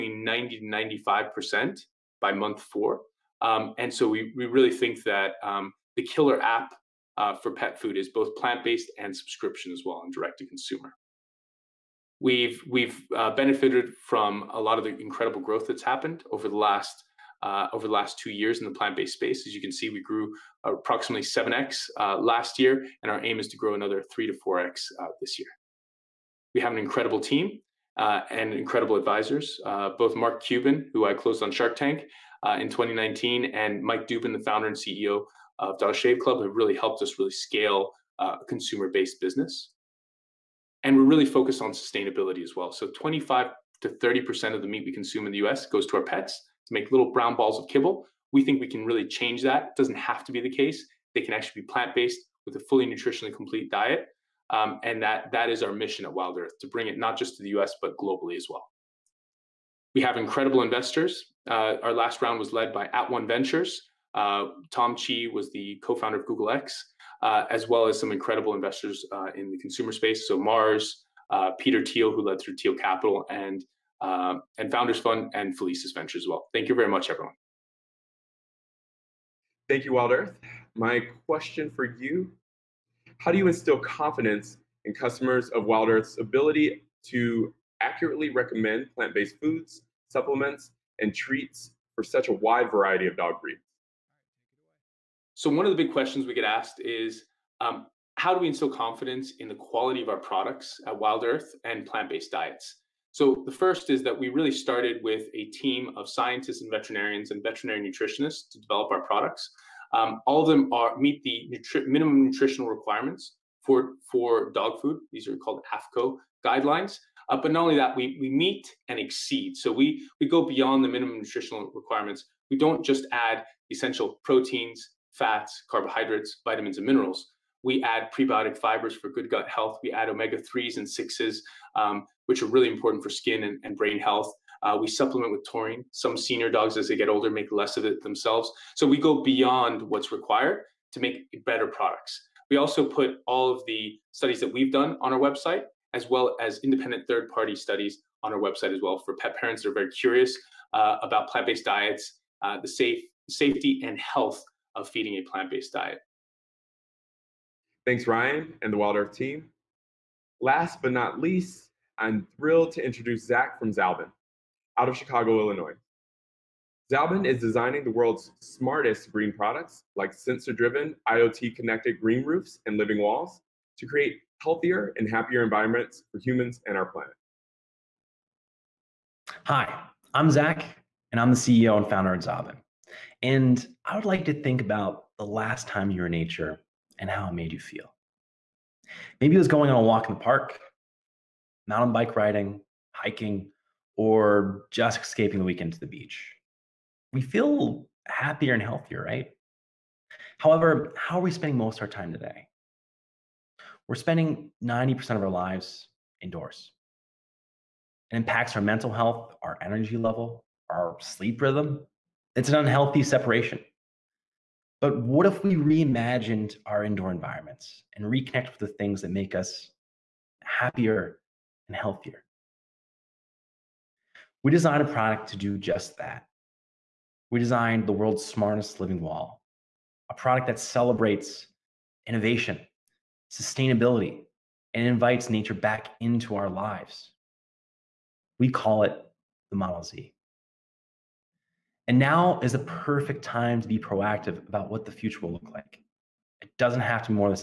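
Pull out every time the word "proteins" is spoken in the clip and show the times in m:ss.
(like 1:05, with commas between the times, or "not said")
2:04.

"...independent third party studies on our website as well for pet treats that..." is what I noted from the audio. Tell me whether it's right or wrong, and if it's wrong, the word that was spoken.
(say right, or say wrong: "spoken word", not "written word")
wrong: "parents", not "treats".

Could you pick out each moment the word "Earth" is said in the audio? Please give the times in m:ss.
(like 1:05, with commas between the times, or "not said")
0:56, 1:20, 1:25, 1:41, 2:38.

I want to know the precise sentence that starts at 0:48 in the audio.
We think we can really change that.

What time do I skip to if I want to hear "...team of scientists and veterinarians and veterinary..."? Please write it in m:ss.
1:45.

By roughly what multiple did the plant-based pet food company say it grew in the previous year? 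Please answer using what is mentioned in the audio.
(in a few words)
7x.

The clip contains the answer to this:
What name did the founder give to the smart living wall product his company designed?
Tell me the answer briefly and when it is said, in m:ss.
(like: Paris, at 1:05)
Model Z, at 3:59.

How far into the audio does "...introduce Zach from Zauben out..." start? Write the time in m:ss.
2:42.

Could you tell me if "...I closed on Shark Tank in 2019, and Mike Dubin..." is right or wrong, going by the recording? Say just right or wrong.
right.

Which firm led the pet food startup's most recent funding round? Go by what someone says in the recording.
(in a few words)
At One Ventures.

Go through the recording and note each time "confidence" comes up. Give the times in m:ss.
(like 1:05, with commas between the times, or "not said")
1:23, 1:38.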